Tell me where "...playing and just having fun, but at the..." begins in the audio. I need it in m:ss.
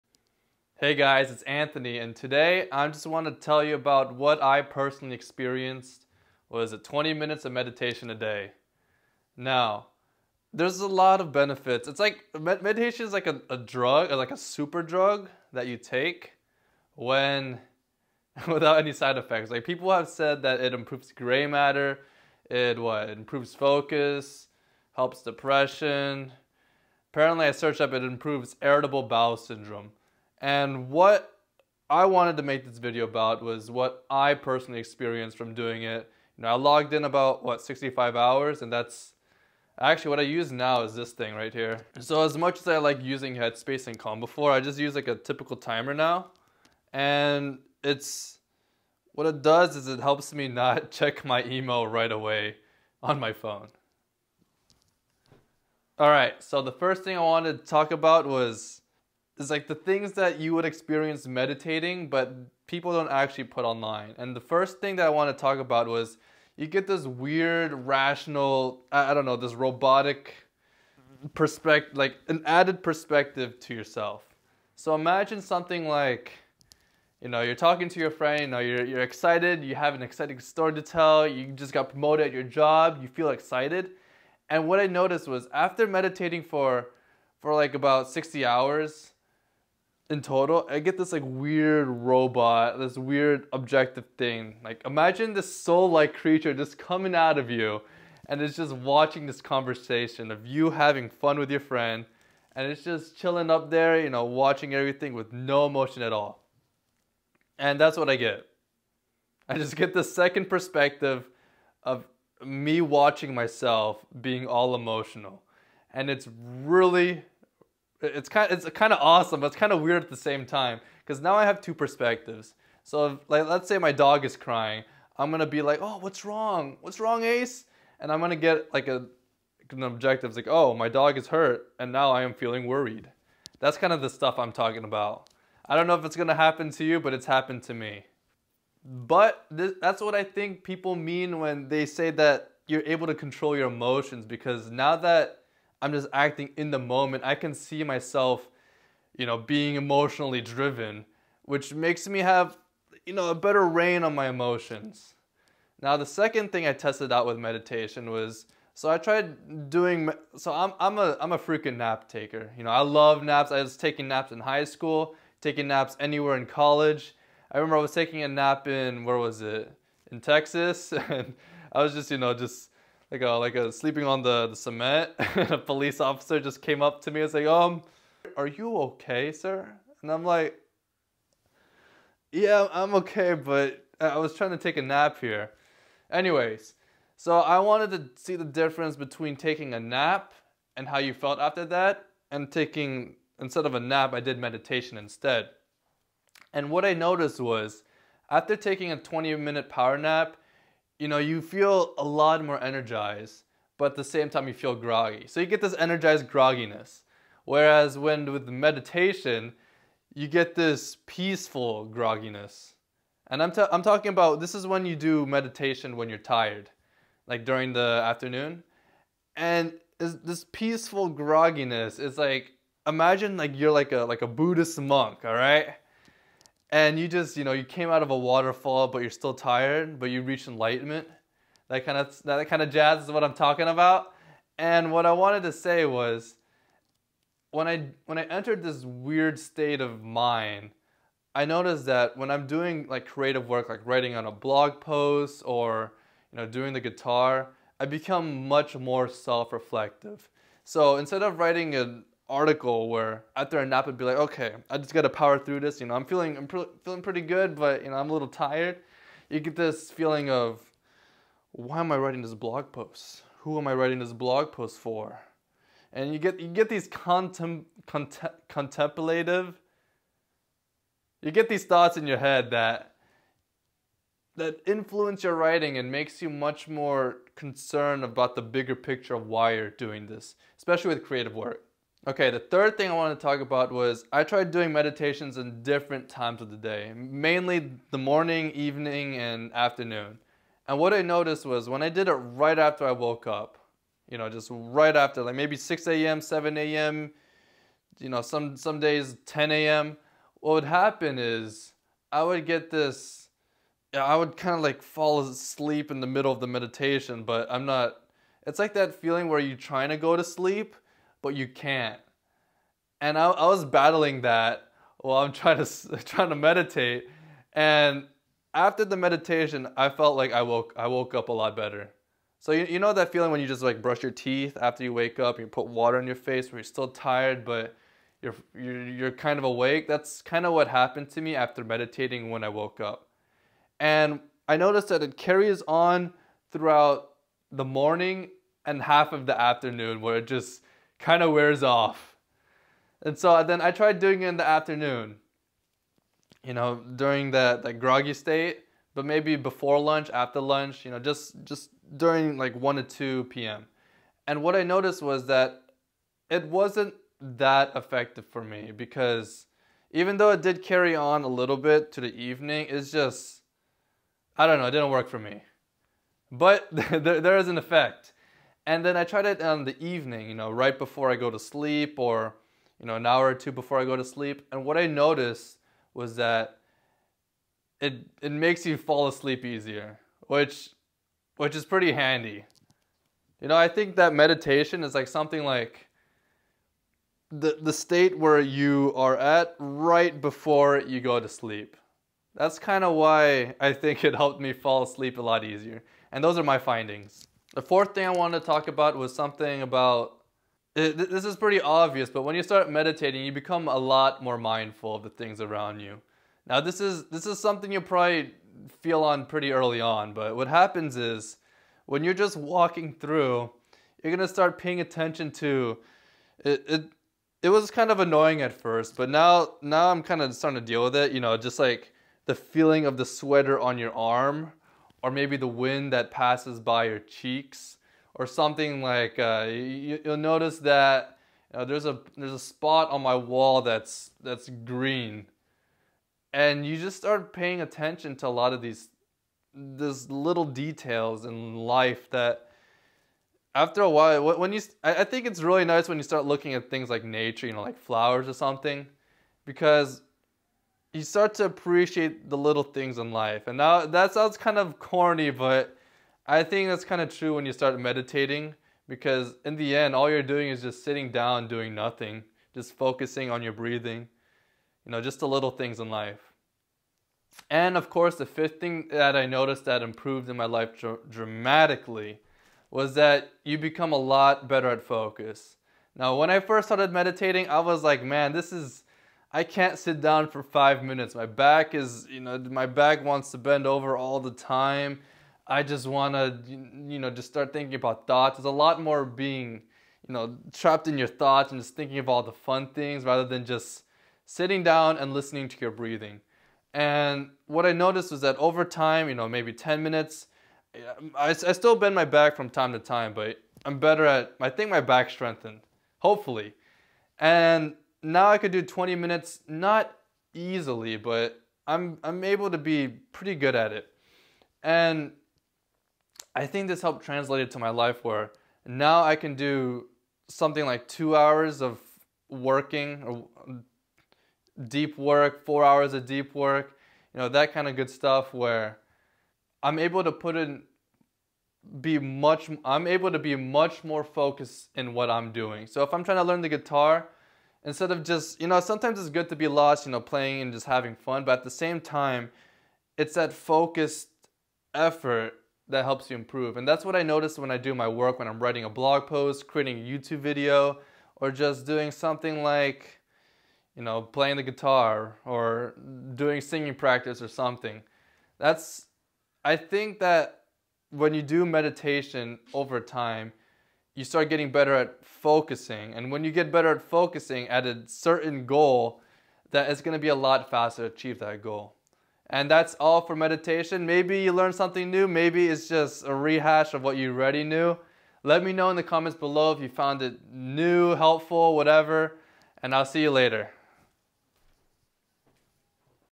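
9:00.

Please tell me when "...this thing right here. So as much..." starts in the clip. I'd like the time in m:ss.
0:40.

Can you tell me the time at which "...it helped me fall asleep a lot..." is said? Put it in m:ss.
6:34.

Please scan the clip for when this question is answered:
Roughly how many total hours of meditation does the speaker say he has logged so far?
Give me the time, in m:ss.
0:37.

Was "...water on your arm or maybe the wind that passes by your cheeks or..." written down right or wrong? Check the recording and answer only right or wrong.
wrong.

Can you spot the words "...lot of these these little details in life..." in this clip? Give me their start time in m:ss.
7:18.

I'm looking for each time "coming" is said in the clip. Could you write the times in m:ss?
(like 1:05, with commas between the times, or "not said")
1:36.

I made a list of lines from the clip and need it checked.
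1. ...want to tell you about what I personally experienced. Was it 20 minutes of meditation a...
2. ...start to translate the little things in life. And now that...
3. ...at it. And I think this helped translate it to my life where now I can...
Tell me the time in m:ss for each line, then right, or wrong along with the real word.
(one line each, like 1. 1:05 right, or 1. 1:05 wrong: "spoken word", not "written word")
1. 0:03 right
2. 7:31 wrong: "appreciate", not "translate"
3. 8:33 right.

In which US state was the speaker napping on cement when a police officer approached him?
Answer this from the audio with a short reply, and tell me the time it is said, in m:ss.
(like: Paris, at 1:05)
Texas, at 2:50.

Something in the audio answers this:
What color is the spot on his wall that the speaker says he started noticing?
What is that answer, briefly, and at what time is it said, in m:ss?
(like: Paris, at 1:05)
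green, at 7:14.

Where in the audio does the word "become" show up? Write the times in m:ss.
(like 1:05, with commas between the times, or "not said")
4:07, 6:43, 7:53.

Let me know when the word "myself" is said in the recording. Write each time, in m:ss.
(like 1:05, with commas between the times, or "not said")
1:53, 2:27.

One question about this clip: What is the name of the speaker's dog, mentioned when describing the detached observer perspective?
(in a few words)
Ace.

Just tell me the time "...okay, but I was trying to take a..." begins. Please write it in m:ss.
3:02.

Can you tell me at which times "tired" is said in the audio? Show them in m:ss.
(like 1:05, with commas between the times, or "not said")
3:36, 3:49, 4:18, 5:26.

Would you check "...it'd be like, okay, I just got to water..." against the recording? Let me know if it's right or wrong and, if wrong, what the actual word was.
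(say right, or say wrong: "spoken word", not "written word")
wrong: "power", not "water".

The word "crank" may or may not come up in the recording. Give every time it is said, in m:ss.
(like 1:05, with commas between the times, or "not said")
not said.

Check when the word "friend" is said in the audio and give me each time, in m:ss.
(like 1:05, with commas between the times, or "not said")
1:18, 1:41.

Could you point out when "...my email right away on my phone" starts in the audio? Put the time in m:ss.
0:51.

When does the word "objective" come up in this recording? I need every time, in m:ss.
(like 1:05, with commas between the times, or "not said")
1:33, 2:09.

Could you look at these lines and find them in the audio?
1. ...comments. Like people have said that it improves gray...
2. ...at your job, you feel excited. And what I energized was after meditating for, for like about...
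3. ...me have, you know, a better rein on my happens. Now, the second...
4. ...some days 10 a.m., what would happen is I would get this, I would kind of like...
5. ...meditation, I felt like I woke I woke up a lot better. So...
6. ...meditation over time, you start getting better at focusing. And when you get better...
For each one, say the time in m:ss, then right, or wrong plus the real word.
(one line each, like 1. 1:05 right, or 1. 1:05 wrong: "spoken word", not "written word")
1. 0:19 wrong: "effects", not "comments"
2. 1:22 wrong: "noticed", not "energized"
3. 2:32 wrong: "emotions", not "happens"
4. 4:58 right
5. 5:18 right
6. 9:21 right.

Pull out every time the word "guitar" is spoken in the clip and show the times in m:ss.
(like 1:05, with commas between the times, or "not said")
4:06, 8:56, 9:14.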